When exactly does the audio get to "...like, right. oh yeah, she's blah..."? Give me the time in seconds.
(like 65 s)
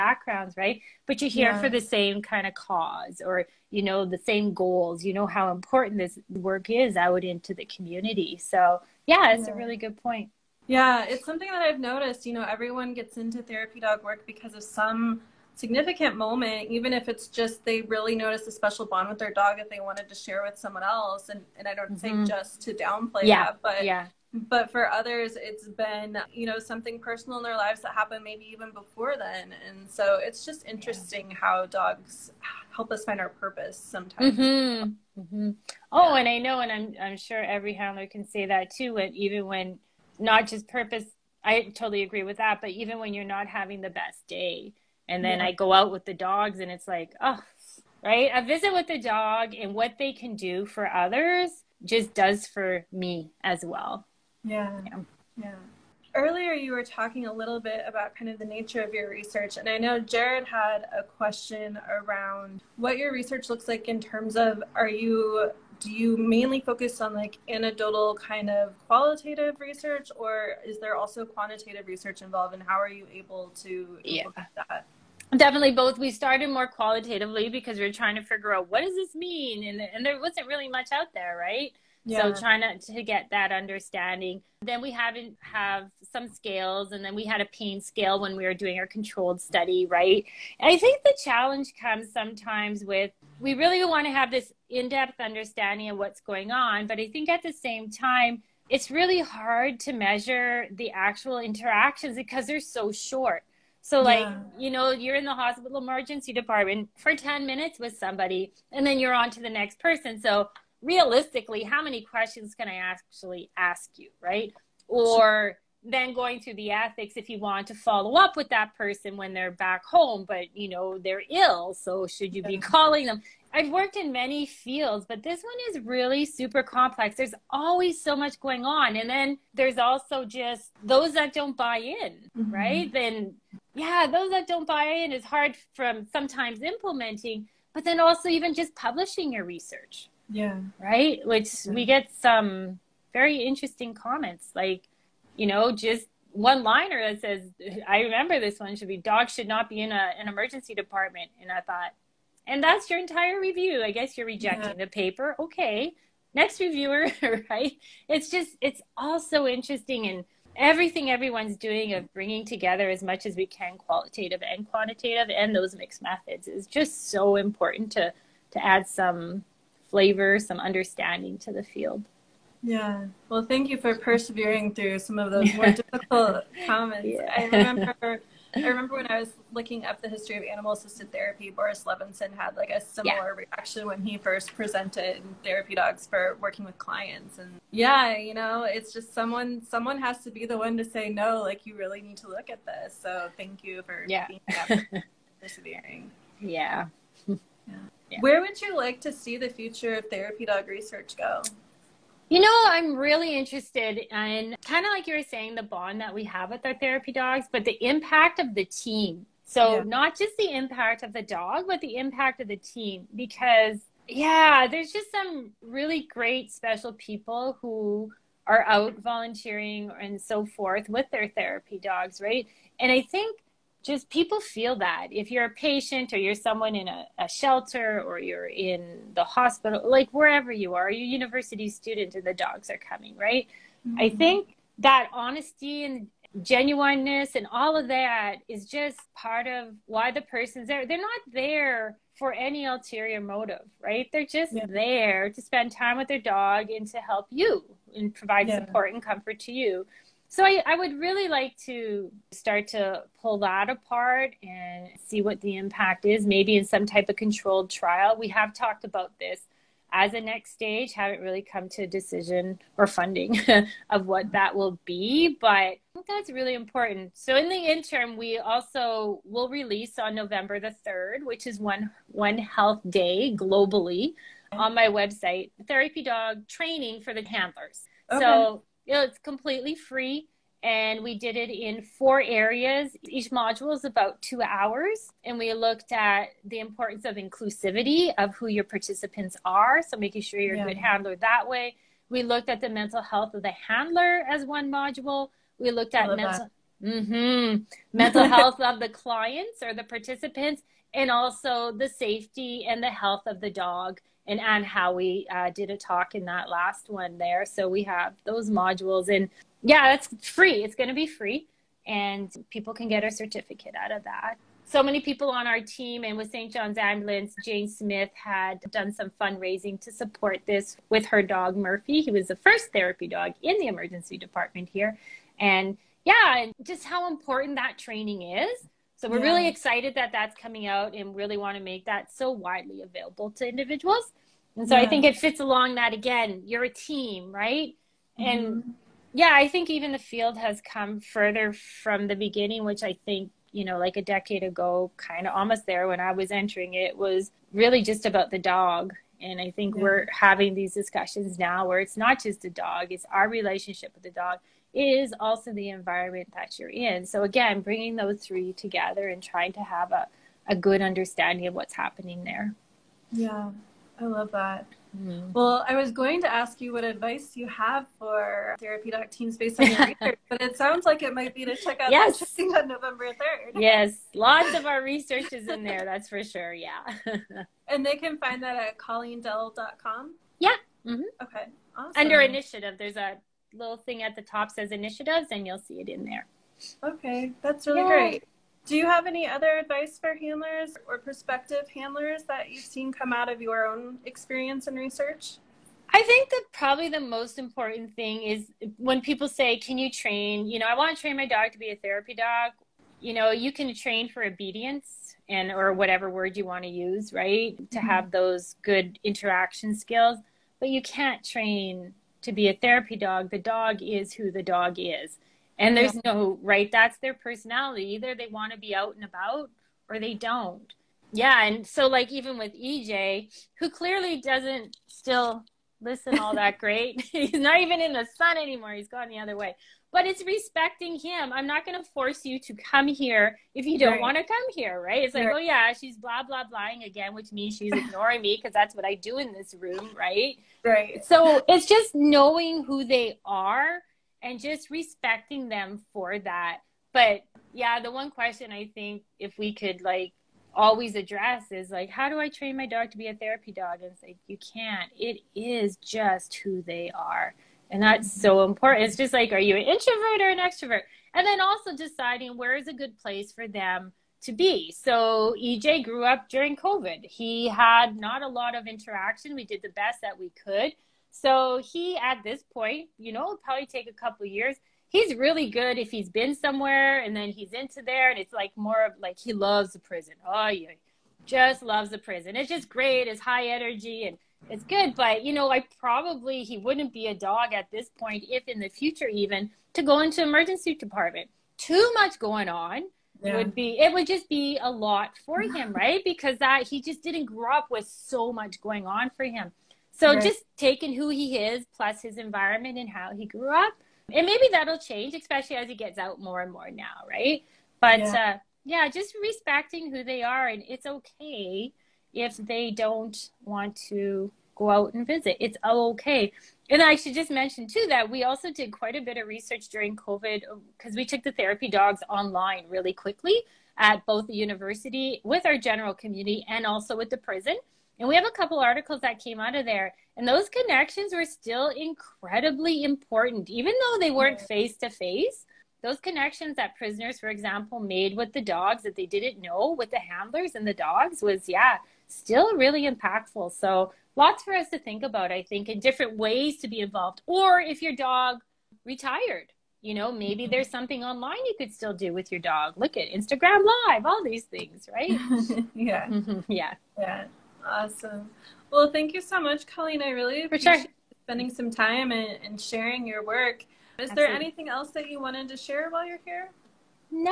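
435 s.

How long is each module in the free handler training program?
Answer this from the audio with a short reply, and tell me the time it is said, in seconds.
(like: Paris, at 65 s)
2 hours, at 284 s.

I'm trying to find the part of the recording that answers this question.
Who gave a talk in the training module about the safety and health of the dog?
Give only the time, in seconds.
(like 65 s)
304 s.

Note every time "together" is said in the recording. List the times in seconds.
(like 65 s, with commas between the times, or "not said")
162 s, 358 s.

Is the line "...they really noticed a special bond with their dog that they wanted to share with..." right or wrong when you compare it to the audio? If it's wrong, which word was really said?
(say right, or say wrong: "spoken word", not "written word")
right.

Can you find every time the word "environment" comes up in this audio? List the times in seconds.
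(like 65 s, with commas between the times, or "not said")
355 s, 502 s.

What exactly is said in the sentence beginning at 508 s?
uh yeah just respecting who they are and it's okay if they don't want to go out and visit.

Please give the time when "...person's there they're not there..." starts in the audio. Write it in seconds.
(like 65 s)
240 s.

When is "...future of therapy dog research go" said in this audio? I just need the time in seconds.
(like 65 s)
199 s.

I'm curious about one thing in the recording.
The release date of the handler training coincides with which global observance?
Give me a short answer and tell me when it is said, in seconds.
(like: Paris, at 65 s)
One Health Day, at 272 s.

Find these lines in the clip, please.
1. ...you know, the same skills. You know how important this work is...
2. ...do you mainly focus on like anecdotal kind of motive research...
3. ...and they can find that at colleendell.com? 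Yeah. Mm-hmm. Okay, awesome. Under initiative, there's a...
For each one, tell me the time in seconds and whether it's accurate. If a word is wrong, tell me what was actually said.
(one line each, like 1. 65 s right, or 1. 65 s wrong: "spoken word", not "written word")
1. 3 s wrong: "goals", not "skills"
2. 65 s wrong: "qualitative", not "motive"
3. 377 s right.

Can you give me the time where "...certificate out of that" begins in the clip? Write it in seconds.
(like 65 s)
313 s.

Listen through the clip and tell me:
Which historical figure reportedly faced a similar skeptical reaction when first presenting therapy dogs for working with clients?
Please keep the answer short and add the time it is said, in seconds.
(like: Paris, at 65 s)
Boris Levinson, at 181 s.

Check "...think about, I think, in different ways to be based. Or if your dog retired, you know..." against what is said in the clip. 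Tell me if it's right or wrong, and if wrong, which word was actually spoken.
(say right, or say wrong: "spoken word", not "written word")
wrong: "involved", not "based".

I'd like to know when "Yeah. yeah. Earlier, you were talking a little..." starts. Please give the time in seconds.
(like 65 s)
54 s.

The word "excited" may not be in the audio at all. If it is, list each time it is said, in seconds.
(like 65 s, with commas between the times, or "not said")
329 s.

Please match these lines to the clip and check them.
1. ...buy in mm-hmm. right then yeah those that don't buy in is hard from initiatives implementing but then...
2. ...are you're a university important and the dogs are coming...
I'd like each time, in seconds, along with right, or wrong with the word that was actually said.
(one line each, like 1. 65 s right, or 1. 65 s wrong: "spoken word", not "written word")
1. 131 s wrong: "sometimes", not "initiatives"
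2. 230 s wrong: "student", not "important".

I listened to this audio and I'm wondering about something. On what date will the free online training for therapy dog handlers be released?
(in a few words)
November 3.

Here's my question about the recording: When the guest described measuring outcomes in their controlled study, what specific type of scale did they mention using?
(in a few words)
pain scale.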